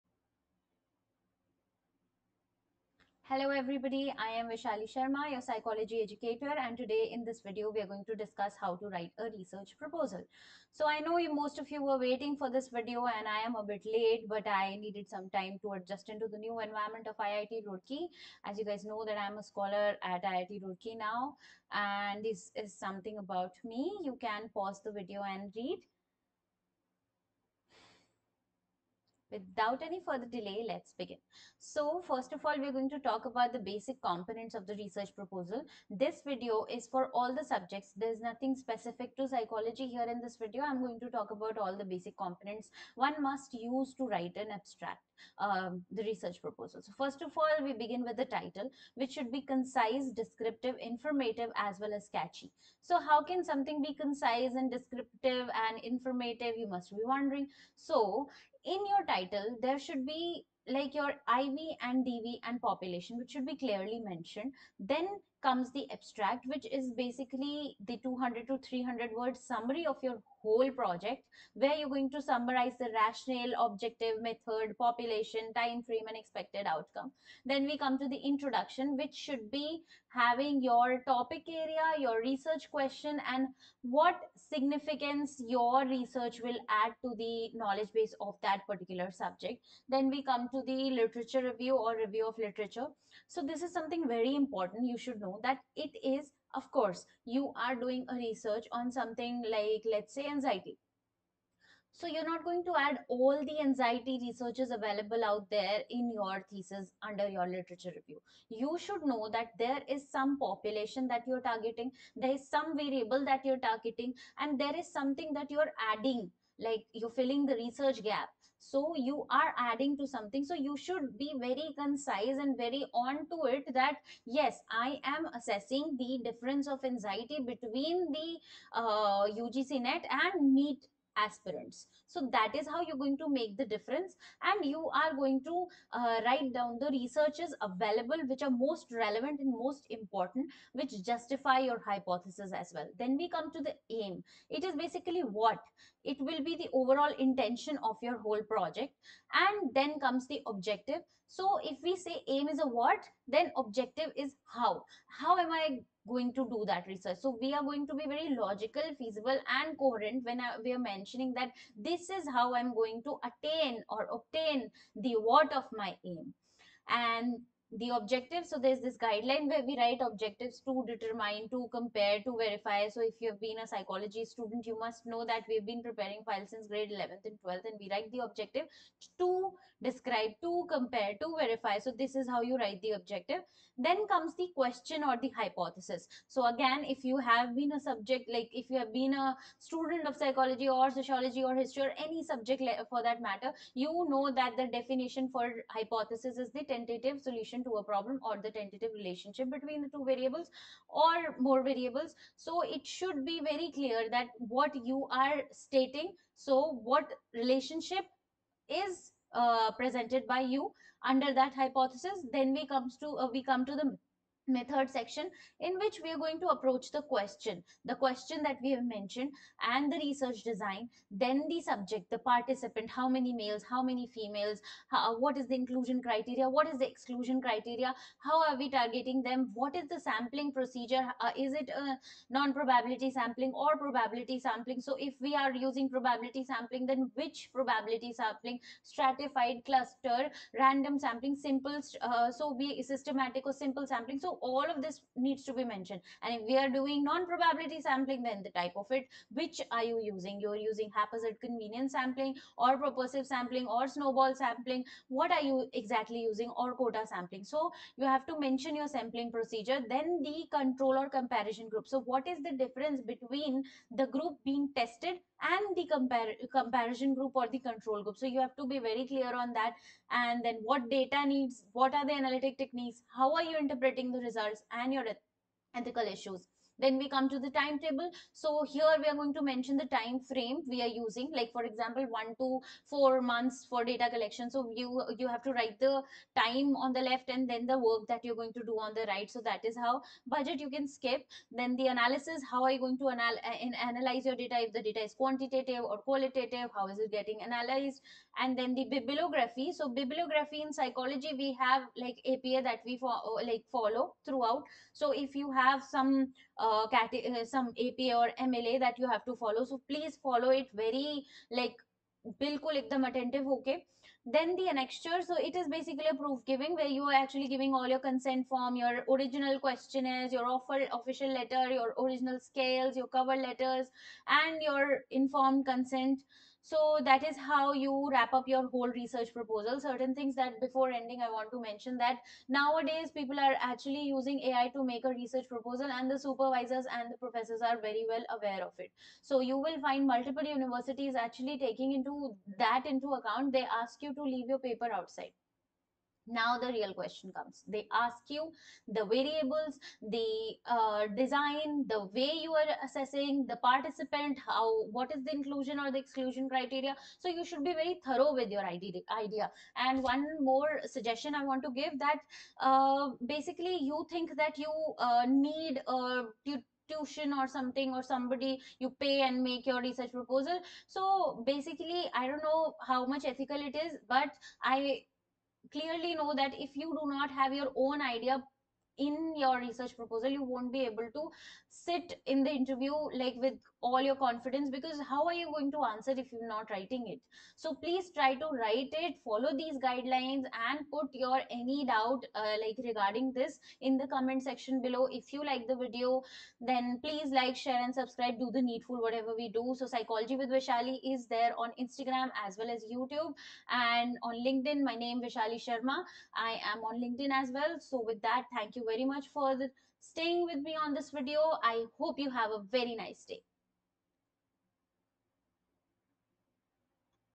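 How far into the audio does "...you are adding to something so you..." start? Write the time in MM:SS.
01:58.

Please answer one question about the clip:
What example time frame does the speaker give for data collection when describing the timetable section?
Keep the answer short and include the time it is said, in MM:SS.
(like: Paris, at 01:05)
1 to 4 months, at 04:42.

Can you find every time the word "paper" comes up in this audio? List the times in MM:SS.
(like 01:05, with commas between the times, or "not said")
05:44.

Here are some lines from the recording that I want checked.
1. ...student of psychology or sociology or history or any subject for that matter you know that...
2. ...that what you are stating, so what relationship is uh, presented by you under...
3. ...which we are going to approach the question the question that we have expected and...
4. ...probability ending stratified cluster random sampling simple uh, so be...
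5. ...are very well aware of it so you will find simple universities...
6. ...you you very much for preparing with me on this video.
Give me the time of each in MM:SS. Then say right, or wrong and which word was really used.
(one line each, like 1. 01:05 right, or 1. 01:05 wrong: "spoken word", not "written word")
1. 03:09 right
2. 03:24 right
3. 03:35 wrong: "mentioned", not "expected"
4. 03:57 wrong: "sampling", not "ending"
5. 05:37 wrong: "multiple", not "simple"
6. 06:48 wrong: "staying", not "preparing".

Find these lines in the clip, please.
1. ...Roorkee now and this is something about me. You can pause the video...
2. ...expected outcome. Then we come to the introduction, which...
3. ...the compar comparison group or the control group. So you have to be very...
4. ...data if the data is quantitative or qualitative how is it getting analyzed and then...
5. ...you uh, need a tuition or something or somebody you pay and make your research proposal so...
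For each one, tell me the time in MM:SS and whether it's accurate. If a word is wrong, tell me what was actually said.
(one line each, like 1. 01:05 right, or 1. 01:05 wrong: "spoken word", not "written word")
1. 00:20 right
2. 01:16 right
3. 04:25 right
4. 04:54 right
5. 06:04 right.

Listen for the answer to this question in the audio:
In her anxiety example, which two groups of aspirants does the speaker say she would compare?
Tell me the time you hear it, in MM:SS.
02:09.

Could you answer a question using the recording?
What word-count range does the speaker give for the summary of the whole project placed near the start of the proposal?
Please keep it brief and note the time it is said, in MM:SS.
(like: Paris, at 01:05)
200 to 300 words, at 01:08.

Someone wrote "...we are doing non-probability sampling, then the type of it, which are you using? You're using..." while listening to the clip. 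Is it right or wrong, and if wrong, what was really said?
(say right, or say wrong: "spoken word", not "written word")
right.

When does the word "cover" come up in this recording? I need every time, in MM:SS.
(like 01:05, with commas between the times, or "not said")
05:23.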